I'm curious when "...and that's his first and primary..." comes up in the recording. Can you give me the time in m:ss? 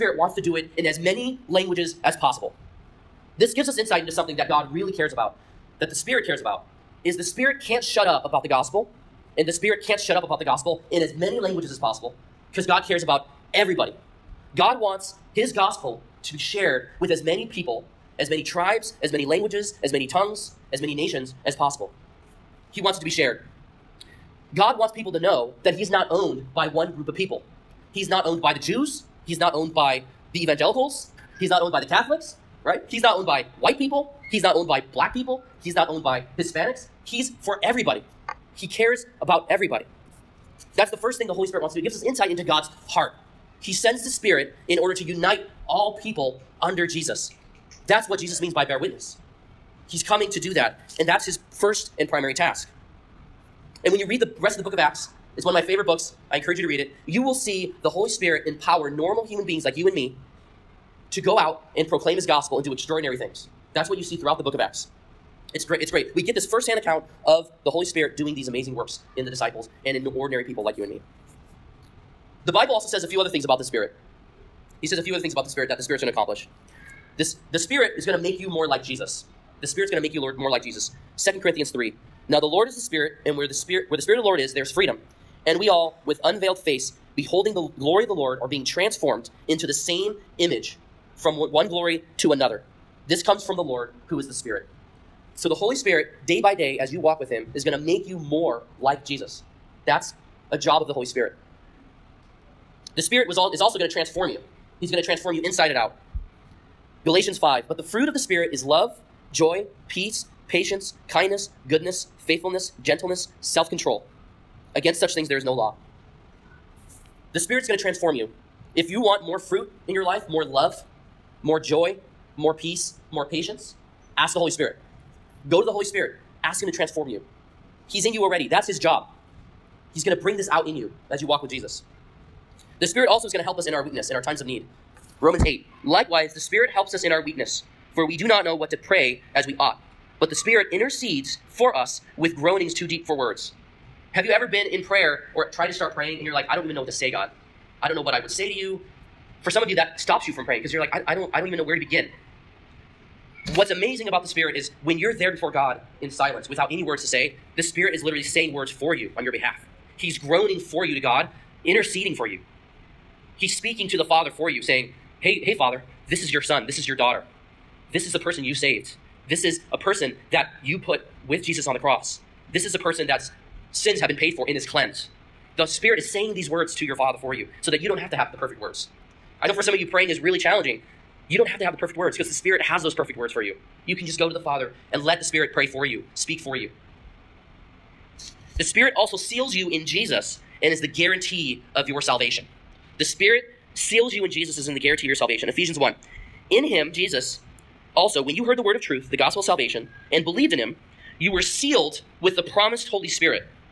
0:50.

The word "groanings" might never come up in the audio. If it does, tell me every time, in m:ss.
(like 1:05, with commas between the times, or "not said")
2:22, 2:40.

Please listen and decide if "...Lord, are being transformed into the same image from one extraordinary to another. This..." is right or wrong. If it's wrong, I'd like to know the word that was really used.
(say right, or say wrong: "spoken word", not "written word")
wrong: "glory", not "extraordinary".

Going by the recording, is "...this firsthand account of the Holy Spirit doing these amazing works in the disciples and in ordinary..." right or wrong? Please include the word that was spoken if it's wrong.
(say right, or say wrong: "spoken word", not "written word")
right.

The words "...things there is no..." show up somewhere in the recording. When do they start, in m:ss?
1:55.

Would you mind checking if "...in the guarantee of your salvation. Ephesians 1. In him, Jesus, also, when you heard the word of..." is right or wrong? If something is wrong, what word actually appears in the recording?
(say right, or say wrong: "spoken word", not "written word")
right.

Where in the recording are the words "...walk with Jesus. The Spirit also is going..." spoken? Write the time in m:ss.
2:11.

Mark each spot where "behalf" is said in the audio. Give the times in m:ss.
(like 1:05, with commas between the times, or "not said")
2:39.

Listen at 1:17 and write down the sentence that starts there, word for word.
This, the Spirit is going to make you more like Jesus.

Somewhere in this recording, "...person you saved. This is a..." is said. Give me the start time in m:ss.
2:48.